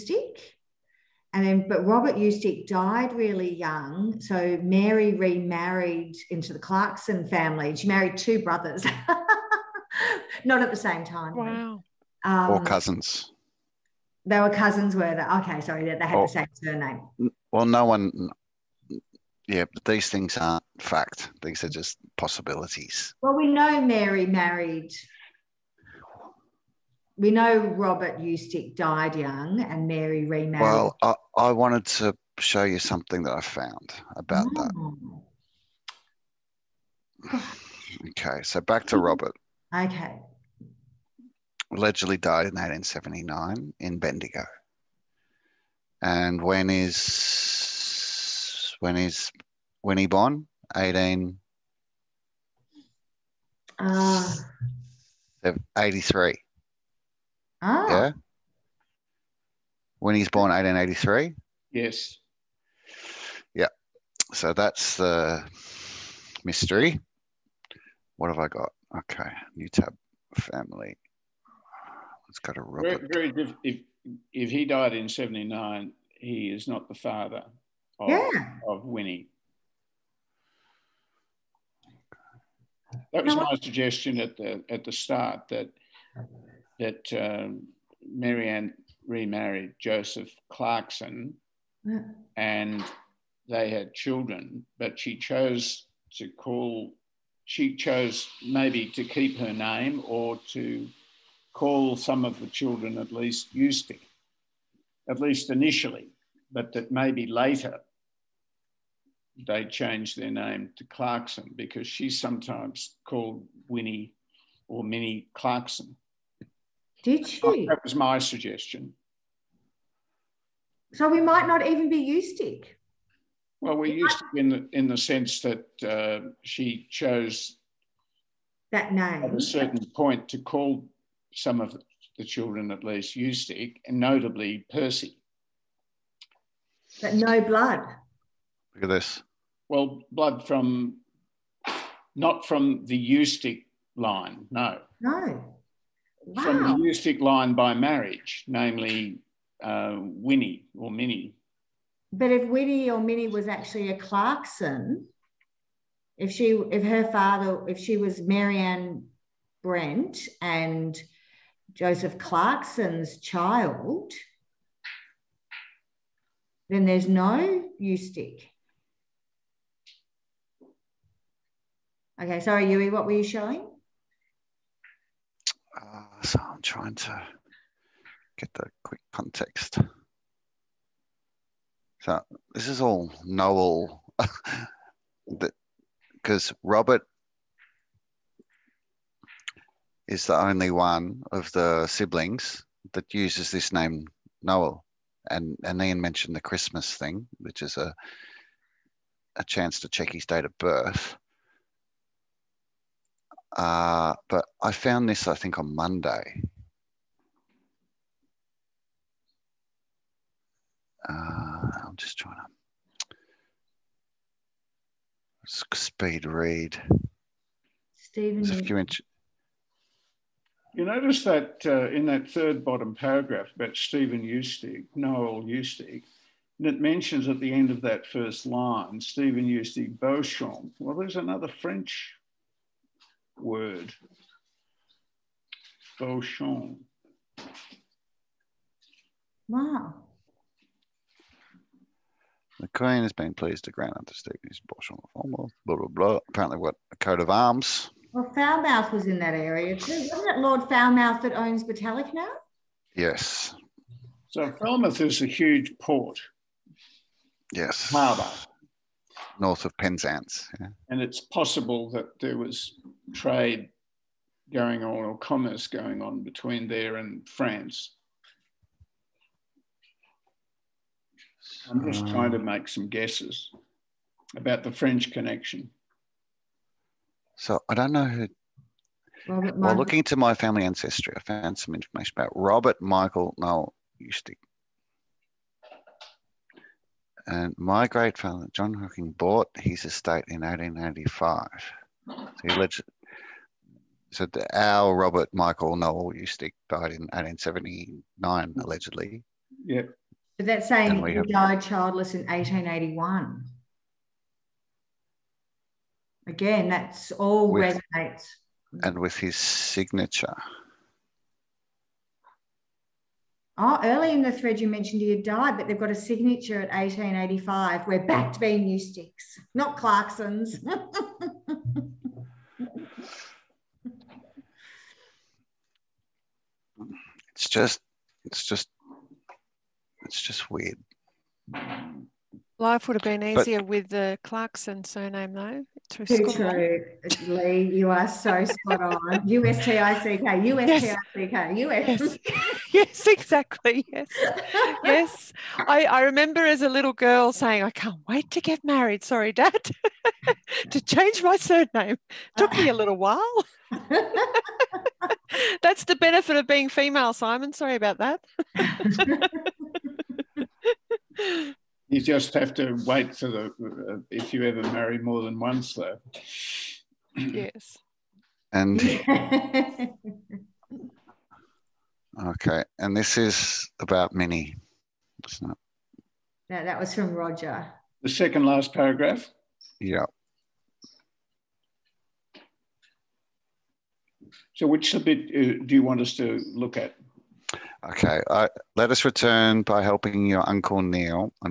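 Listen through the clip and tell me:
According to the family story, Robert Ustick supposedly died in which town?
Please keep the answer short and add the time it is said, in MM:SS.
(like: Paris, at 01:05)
Bendigo, at 00:43.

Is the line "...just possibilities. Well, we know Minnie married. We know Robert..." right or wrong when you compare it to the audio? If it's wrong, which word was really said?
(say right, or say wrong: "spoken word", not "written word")
wrong: "Mary", not "Minnie".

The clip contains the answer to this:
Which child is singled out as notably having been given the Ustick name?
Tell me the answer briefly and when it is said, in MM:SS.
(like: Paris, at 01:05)
Percy, at 02:14.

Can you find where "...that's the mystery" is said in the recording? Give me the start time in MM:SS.
01:04.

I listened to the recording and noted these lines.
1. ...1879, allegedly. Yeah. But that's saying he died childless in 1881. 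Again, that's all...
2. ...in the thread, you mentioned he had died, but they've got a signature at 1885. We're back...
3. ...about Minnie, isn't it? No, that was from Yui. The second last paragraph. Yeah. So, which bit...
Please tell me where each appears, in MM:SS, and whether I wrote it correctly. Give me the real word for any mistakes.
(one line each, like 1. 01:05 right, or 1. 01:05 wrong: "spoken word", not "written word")
1. 04:57 right
2. 05:14 right
3. 06:13 wrong: "Roger", not "Yui".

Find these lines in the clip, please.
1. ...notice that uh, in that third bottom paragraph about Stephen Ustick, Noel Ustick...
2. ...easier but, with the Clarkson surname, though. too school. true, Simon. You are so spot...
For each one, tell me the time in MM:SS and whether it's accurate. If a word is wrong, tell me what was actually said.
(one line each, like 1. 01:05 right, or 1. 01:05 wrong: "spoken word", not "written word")
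1. 03:40 right
2. 05:33 wrong: "Lee", not "Simon".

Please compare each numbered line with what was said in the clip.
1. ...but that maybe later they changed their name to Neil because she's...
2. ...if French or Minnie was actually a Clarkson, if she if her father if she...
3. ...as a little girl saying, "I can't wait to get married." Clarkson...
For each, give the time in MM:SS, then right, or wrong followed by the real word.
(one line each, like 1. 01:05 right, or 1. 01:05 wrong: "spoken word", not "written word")
1. 01:46 wrong: "Clarkson", not "Neil"
2. 02:32 wrong: "Winnie", not "French"
3. 05:46 wrong: "Sorry", not "Clarkson".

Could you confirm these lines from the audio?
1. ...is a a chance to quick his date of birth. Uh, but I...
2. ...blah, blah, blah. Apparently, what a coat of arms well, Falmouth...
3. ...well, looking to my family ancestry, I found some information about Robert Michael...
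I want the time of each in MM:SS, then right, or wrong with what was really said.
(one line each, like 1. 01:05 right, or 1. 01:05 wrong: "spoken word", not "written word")
1. 03:17 wrong: "check", not "quick"
2. 04:05 right
3. 04:39 right.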